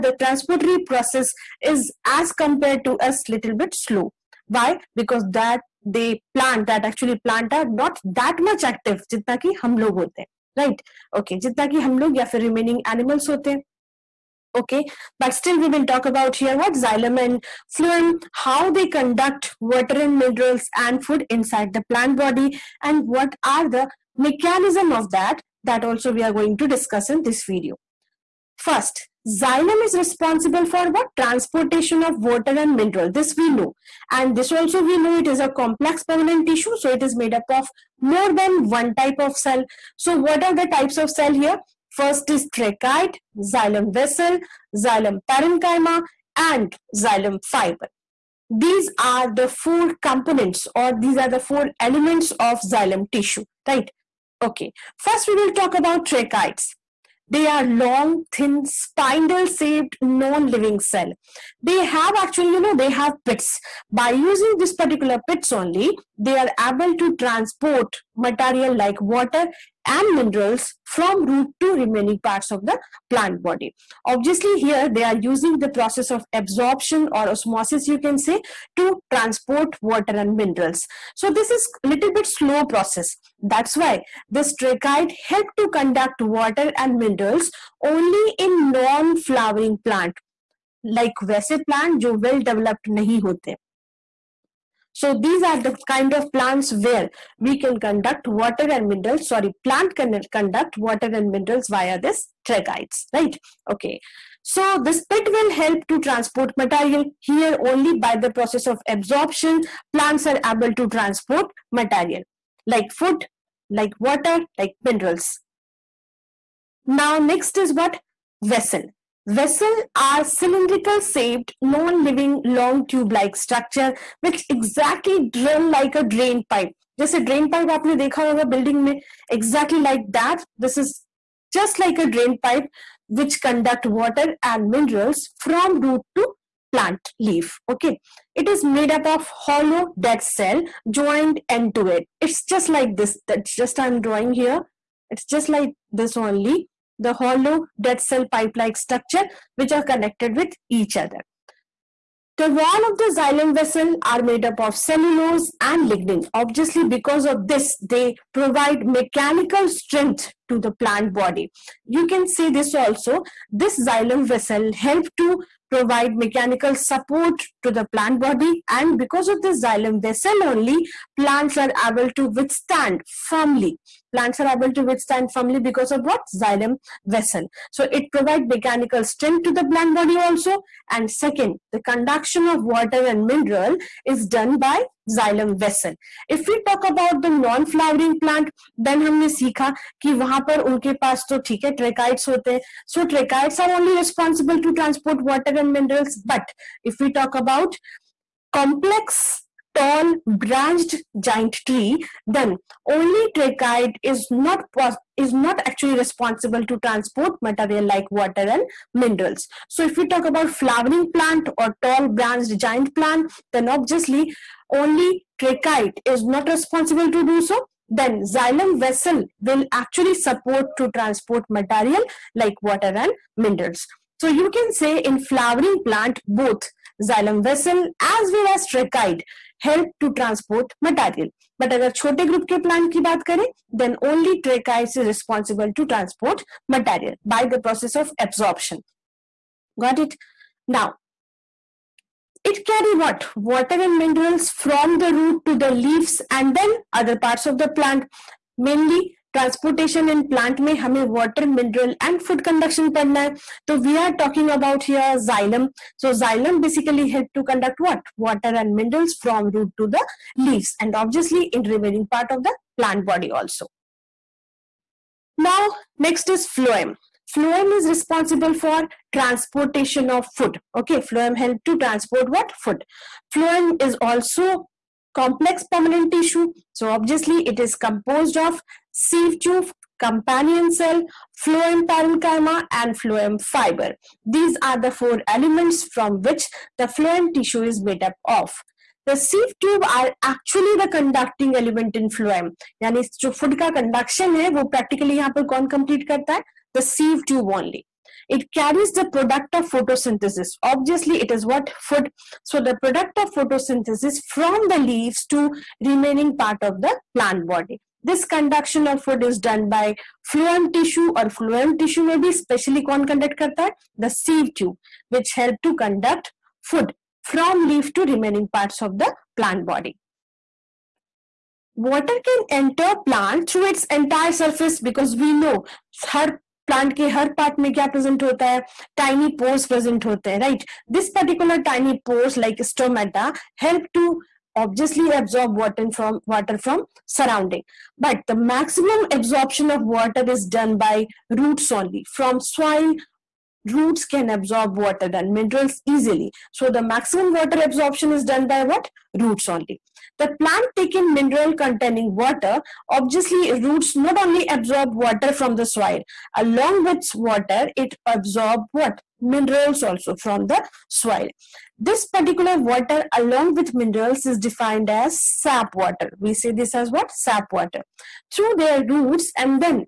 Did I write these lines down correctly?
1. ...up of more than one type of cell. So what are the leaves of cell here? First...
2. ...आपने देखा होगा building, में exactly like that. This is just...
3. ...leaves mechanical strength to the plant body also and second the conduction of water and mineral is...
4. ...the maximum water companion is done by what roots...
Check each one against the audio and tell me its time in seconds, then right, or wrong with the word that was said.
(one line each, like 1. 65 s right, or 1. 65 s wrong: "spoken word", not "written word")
1. 37 s wrong: "types", not "leaves"
2. 127 s right
3. 178 s wrong: "provides", not "leaves"
4. 346 s wrong: "absorption", not "companion".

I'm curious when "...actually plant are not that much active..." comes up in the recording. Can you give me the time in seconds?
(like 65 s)
6 s.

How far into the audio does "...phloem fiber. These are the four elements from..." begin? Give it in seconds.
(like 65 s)
282 s.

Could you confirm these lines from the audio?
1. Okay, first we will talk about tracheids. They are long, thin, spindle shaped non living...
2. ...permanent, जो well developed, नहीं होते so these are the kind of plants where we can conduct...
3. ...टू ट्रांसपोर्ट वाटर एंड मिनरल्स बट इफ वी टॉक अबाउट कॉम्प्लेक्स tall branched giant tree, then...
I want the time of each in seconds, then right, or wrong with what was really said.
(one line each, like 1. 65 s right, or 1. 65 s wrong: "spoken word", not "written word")
1. 54 s right
2. 91 s wrong: "plant", not "permanent"
3. 194 s right.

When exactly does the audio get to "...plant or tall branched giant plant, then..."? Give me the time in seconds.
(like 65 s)
211 s.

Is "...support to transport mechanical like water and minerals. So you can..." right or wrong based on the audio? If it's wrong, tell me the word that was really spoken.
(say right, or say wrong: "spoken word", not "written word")
wrong: "material", not "mechanical".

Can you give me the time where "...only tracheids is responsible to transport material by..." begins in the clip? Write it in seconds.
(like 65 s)
234 s.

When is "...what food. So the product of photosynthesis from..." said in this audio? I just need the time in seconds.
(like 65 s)
301 s.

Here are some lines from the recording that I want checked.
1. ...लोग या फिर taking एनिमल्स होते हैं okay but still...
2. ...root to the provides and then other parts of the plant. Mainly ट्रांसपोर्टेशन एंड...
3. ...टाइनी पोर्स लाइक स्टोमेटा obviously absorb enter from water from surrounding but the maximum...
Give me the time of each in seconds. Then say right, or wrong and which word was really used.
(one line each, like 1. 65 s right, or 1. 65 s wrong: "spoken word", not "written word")
1. 11 s wrong: "remaining", not "taking"
2. 245 s wrong: "leaves", not "provides"
3. 331 s wrong: "water", not "enter".